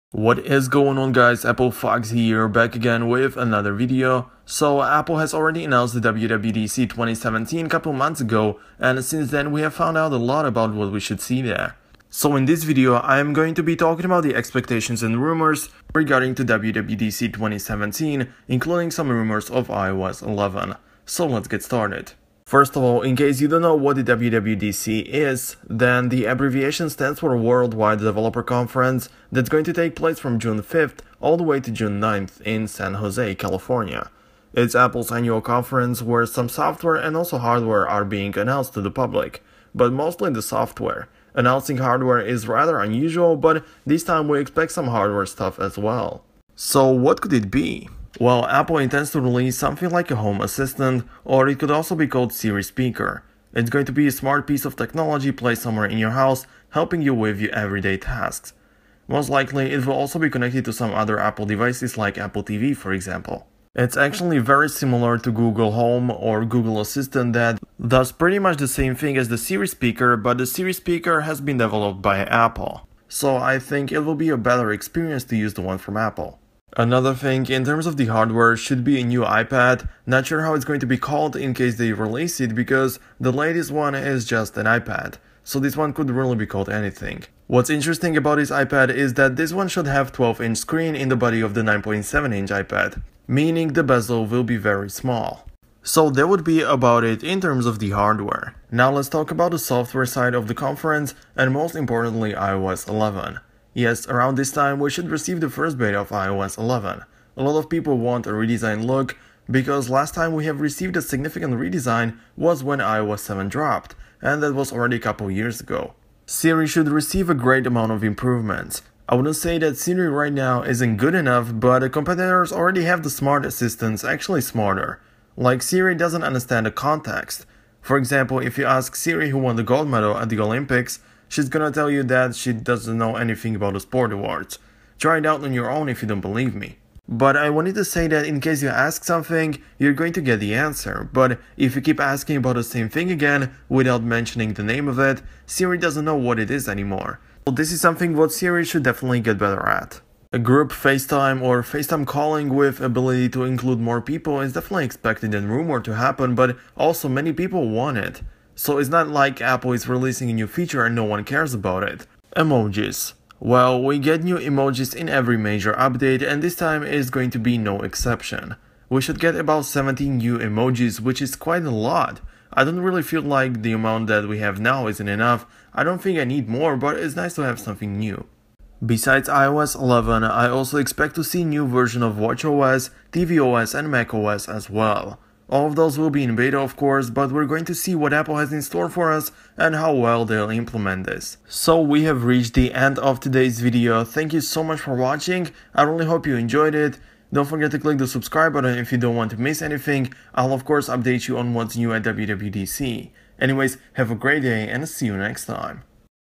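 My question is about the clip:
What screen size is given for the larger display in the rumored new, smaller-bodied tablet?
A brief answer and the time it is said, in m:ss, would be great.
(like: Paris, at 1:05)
12-inch, at 1:30.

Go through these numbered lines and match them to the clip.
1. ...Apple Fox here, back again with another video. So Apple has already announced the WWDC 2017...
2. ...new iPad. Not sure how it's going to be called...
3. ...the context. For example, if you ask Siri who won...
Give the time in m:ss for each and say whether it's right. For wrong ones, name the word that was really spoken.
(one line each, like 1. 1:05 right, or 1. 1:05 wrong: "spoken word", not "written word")
1. 0:01 right
2. 1:19 right
3. 2:06 right.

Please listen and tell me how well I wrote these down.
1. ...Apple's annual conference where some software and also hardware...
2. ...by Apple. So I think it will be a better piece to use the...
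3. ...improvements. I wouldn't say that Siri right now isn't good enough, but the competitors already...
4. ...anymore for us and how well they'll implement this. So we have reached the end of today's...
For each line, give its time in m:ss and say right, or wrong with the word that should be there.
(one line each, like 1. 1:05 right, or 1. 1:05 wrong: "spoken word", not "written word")
1. 0:34 right
2. 1:12 wrong: "experience", not "piece"
3. 1:58 right
4. 3:08 wrong: "store", not "anymore".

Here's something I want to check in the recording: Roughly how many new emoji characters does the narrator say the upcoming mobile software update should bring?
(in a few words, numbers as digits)
17.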